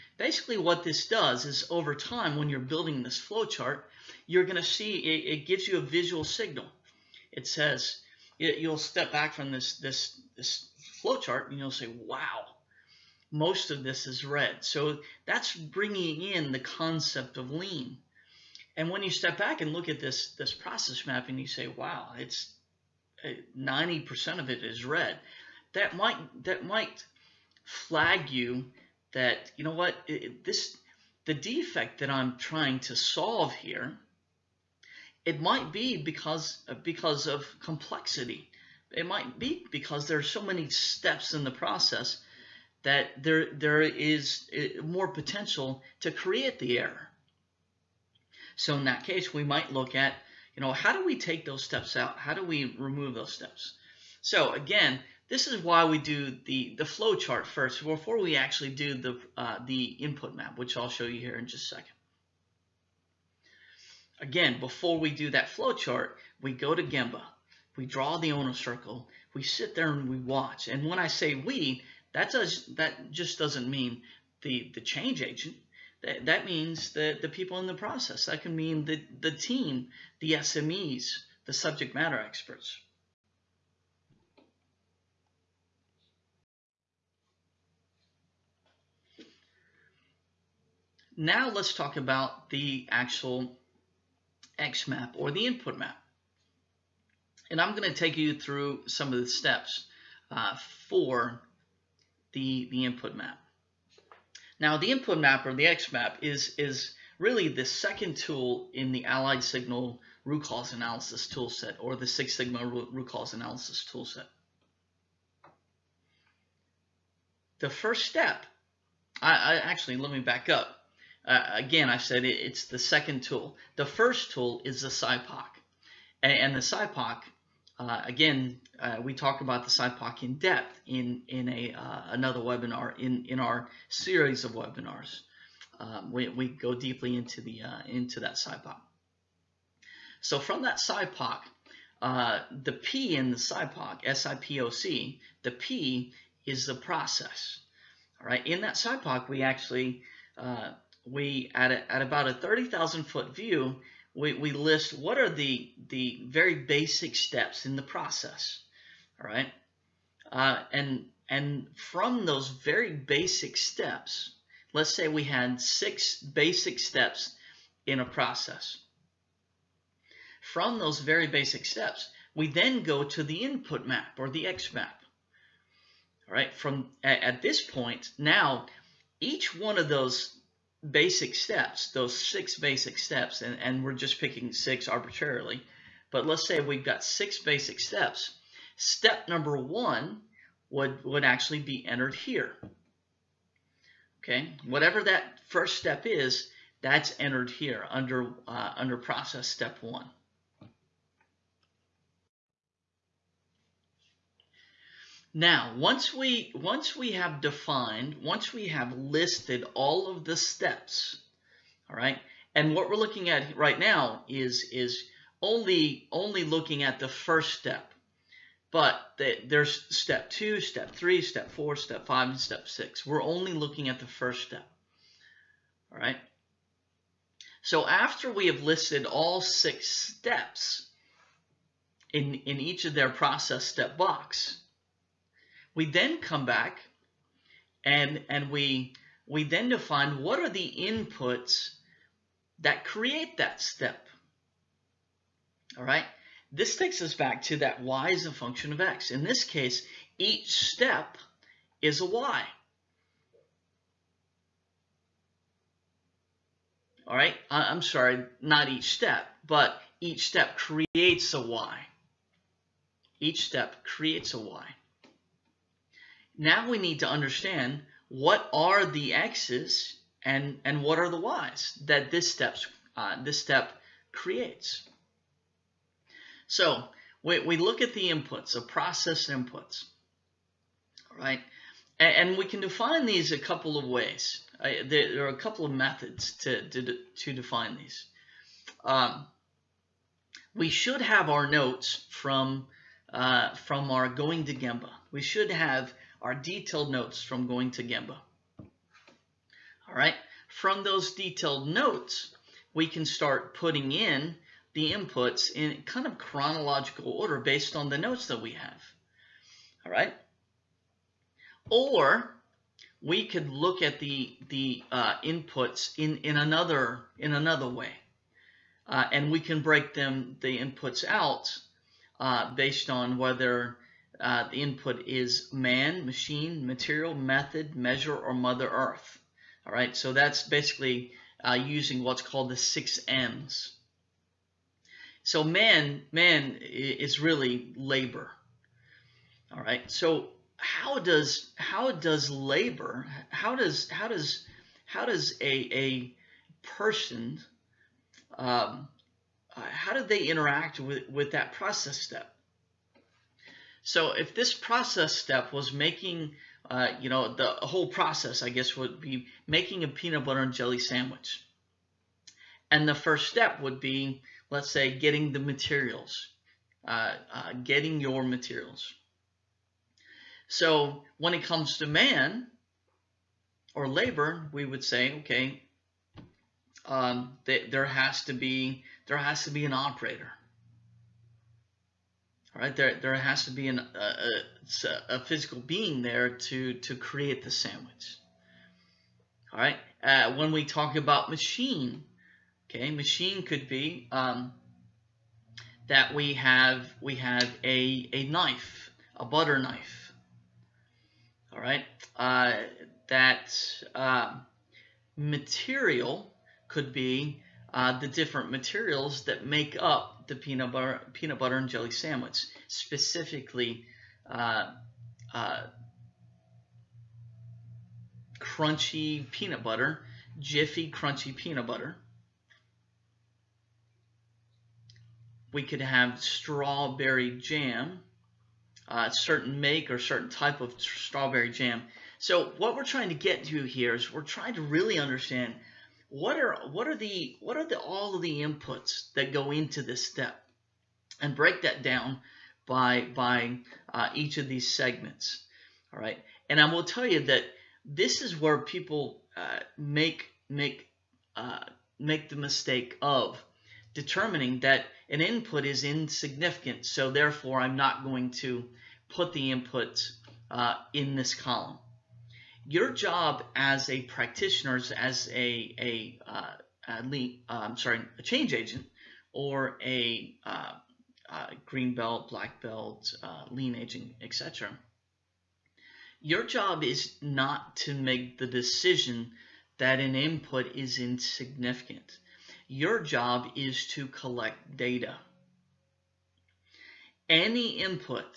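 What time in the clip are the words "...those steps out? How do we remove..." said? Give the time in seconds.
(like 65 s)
51 s.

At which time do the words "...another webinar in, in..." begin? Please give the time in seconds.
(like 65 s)
132 s.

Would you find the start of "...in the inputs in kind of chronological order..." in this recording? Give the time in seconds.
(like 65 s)
303 s.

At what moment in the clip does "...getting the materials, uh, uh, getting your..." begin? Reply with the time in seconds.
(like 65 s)
364 s.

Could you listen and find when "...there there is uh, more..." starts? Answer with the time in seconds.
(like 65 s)
43 s.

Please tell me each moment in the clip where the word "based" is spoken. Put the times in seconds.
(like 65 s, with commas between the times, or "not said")
307 s, 322 s.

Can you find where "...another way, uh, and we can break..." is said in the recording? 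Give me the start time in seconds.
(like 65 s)
317 s.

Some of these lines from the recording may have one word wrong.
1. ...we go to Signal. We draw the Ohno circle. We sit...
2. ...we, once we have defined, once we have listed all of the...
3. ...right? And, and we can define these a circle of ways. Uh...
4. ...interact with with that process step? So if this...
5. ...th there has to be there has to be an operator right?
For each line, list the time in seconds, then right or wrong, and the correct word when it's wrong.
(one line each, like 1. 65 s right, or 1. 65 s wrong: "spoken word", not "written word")
1. 66 s wrong: "Gemba", not "Signal"
2. 206 s right
3. 281 s wrong: "couple", not "circle"
4. 350 s right
5. 377 s right.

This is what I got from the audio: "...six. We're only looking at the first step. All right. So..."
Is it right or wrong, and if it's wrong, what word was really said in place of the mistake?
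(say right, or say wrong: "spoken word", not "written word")
right.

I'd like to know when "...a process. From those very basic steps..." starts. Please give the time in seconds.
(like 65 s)
167 s.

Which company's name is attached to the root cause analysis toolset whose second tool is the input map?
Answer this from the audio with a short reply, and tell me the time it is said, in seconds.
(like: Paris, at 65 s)
Allied Signal, at 109 s.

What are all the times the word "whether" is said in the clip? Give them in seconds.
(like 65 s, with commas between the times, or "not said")
323 s.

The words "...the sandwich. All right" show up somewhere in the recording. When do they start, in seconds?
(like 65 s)
387 s.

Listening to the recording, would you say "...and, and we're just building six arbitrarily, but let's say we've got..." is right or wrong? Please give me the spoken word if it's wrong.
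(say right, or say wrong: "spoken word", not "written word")
wrong: "picking", not "building".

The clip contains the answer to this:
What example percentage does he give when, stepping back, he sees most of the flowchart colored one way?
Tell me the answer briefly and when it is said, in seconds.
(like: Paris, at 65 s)
90%, at 23 s.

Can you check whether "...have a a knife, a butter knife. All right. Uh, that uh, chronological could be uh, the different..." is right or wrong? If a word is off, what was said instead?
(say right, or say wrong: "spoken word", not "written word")
wrong: "material", not "chronological".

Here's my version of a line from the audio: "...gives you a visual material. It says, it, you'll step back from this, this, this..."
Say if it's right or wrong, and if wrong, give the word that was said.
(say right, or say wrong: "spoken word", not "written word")
wrong: "signal", not "material".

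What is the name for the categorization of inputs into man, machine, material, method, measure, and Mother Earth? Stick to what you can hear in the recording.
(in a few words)
six M's.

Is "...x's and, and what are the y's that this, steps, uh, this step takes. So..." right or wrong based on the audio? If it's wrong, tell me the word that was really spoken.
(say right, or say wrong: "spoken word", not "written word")
wrong: "creates", not "takes".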